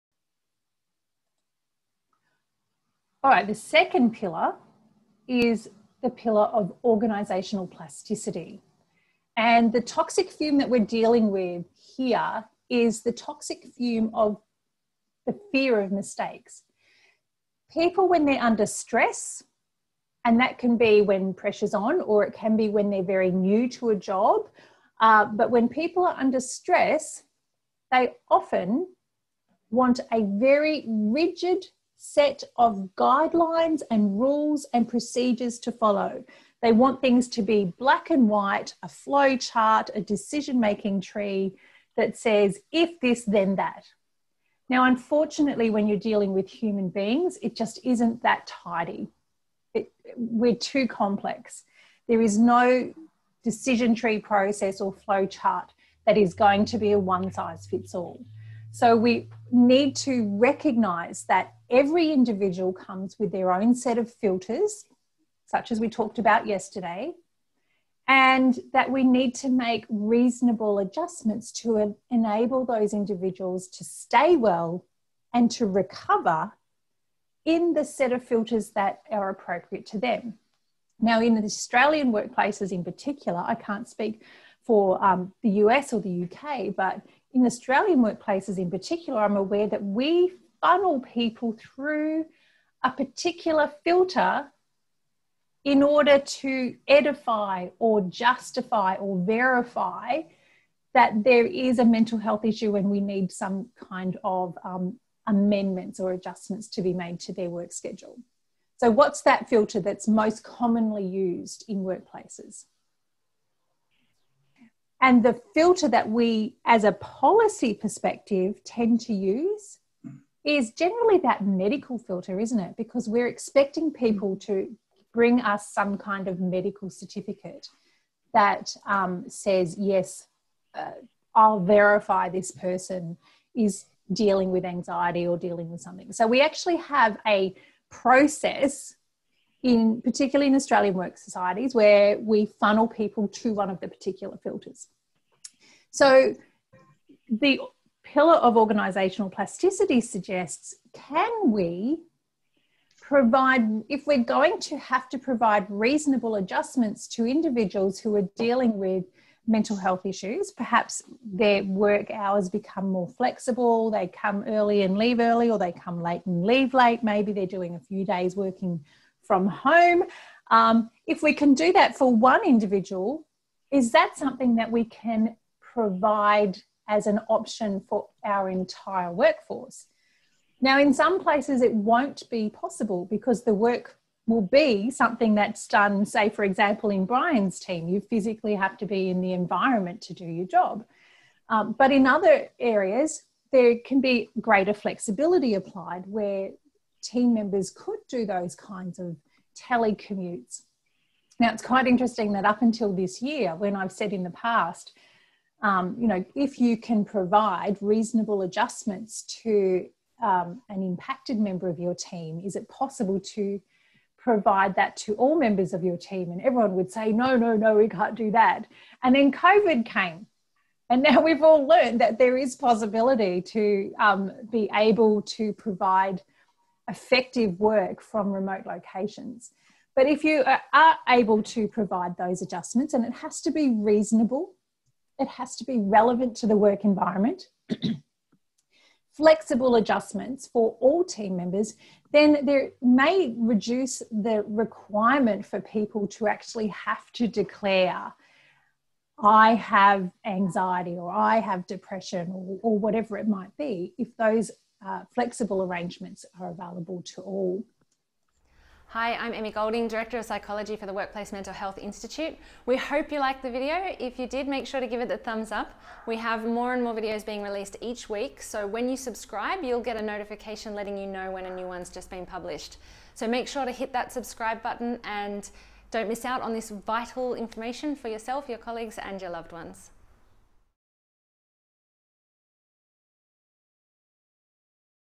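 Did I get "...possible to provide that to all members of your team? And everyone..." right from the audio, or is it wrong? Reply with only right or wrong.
right.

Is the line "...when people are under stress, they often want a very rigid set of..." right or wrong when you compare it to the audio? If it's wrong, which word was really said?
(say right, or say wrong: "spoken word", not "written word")
right.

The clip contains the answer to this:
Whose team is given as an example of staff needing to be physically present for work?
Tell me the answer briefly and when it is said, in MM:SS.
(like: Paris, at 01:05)
Brian, at 03:07.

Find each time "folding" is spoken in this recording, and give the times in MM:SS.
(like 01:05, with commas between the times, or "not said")
not said.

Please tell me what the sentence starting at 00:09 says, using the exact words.
And the toxic fume that we're dealing with here is the toxic fume of the fear of mistakes.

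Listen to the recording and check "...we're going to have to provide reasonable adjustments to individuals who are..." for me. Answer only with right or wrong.
right.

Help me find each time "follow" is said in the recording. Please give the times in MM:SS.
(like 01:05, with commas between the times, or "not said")
00:35.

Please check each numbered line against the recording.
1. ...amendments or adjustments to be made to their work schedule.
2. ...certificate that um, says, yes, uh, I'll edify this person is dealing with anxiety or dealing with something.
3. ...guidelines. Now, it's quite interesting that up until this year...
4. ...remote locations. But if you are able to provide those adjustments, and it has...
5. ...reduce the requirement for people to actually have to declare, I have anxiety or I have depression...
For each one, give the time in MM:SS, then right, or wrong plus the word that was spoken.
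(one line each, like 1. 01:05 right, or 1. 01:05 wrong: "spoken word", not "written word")
1. 01:45 right
2. 02:06 wrong: "verify", not "edify"
3. 03:19 wrong: "telecommutes", not "guidelines"
4. 03:48 right
5. 04:03 right.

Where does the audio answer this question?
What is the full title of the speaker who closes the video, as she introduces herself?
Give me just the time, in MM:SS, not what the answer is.
04:19.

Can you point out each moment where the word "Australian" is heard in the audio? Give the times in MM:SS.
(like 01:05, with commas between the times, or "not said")
01:21, 01:27, 02:20.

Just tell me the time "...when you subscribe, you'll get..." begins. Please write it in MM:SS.
04:28.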